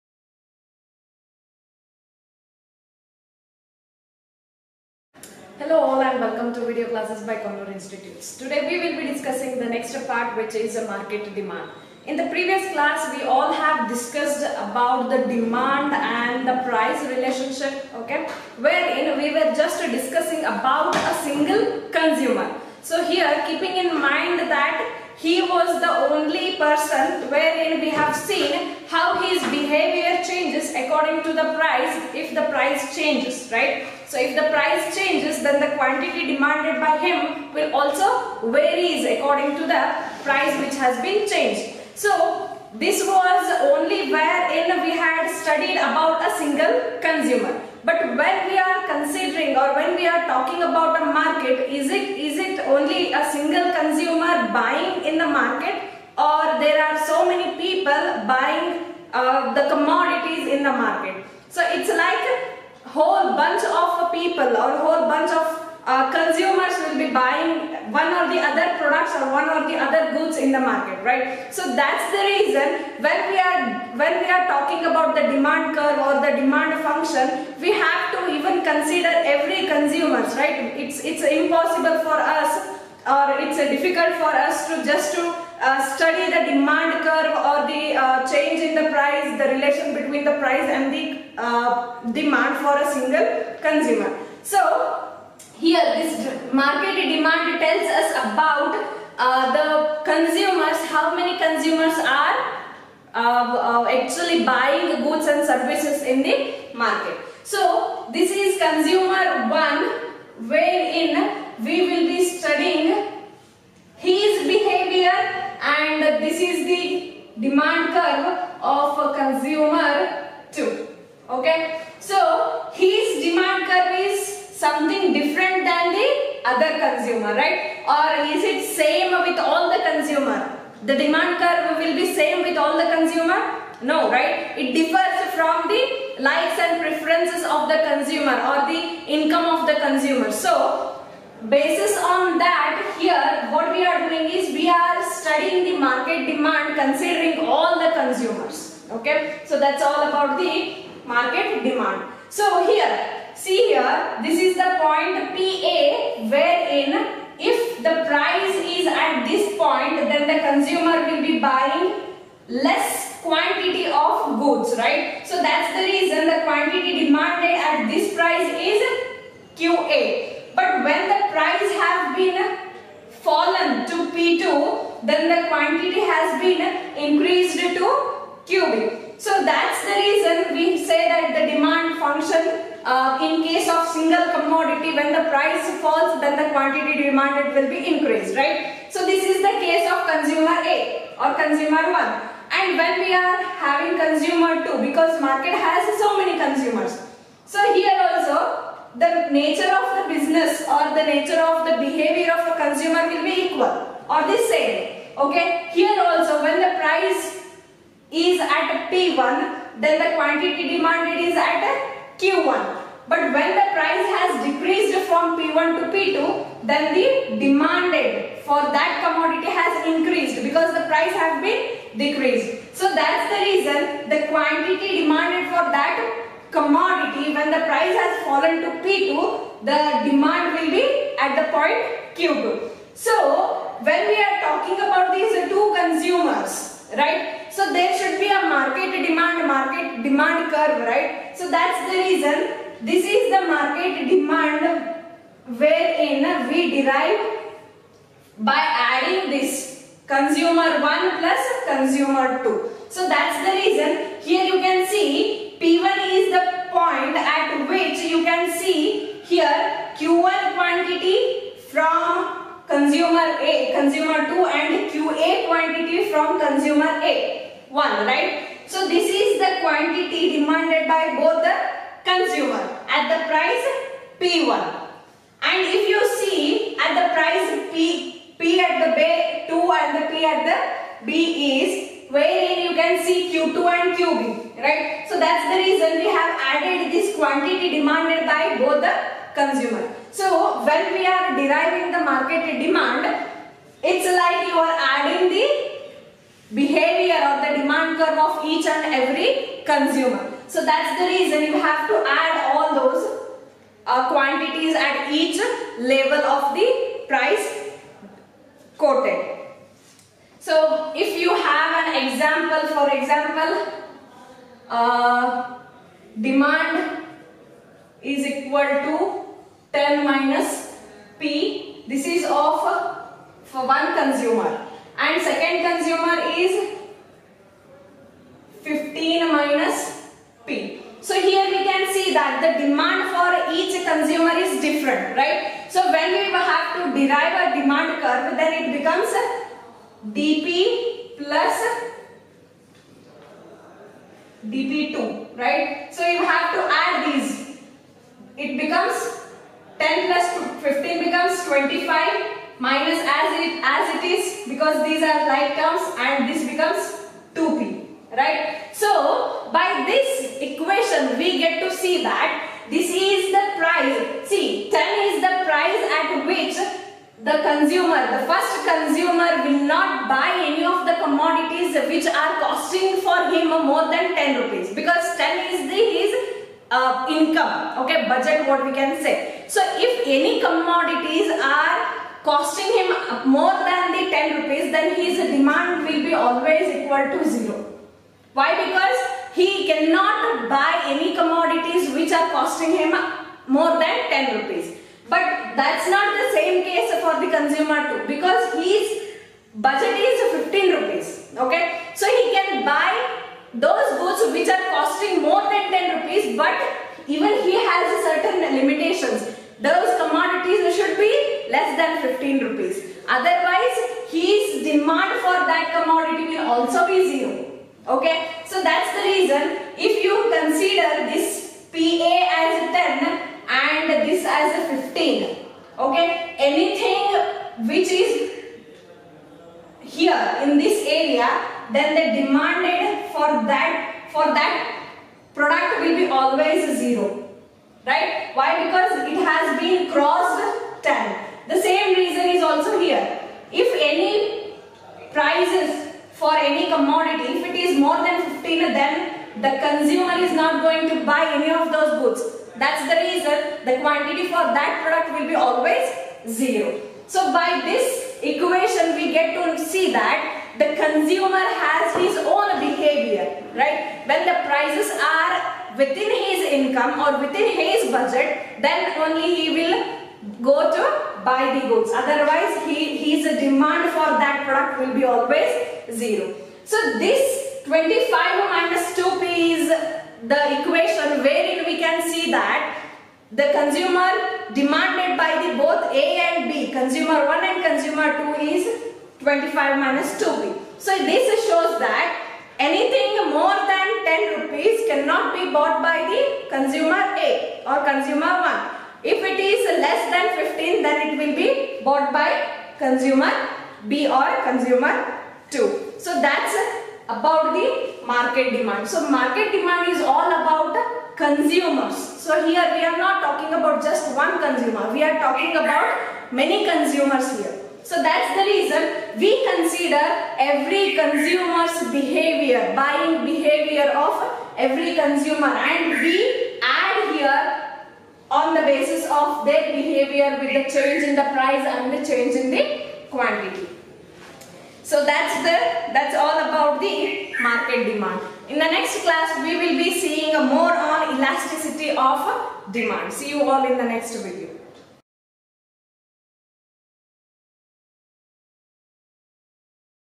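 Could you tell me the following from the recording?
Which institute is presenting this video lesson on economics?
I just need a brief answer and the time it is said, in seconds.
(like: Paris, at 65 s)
Konnur Institutes, at 7 s.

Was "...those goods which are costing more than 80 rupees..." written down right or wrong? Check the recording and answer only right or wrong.
wrong.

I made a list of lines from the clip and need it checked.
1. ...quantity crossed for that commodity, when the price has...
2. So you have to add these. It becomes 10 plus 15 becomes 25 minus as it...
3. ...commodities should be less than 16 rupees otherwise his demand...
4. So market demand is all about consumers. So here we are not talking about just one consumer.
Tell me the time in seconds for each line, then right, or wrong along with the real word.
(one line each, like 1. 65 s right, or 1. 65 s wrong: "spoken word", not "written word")
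1. 224 s wrong: "demanded", not "crossed"
2. 345 s right
3. 410 s wrong: "15", not "16"
4. 508 s right.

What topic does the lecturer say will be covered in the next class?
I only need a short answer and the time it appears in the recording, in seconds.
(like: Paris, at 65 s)
elasticity of demand, at 541 s.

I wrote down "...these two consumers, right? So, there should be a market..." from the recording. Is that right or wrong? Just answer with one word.
right.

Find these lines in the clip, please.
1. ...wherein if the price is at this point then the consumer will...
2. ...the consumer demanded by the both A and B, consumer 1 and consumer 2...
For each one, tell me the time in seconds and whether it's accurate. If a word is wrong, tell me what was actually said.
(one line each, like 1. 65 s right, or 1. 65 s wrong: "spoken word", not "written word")
1. 156 s right
2. 483 s right.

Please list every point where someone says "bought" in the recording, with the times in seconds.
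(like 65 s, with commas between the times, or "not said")
495 s, 501 s.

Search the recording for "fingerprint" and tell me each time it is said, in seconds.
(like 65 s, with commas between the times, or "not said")
not said.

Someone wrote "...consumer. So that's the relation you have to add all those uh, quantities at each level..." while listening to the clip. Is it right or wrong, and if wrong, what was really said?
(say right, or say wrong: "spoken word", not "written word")
wrong: "reason", not "relation".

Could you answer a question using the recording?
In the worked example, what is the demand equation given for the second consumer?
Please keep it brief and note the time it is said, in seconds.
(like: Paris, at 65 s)
15 minus P, at 328 s.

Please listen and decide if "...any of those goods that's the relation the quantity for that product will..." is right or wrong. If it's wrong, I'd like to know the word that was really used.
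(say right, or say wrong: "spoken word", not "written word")
wrong: "reason", not "relation".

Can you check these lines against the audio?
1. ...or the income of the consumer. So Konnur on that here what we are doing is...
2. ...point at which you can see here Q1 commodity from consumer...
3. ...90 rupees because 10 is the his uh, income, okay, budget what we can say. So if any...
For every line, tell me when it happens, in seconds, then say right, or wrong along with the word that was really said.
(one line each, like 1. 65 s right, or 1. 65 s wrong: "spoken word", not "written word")
1. 138 s wrong: "Basis", not "Konnur"
2. 256 s wrong: "quantity", not "commodity"
3. 374 s wrong: "10", not "90".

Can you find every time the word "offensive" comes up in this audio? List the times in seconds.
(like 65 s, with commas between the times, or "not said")
not said.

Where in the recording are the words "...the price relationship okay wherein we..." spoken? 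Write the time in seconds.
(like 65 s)
16 s.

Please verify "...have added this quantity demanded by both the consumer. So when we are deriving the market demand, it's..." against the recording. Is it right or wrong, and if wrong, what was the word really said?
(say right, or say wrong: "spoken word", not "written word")
right.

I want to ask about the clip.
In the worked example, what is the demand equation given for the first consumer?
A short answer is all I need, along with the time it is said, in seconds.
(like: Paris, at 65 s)
10 minus P, at 319 s.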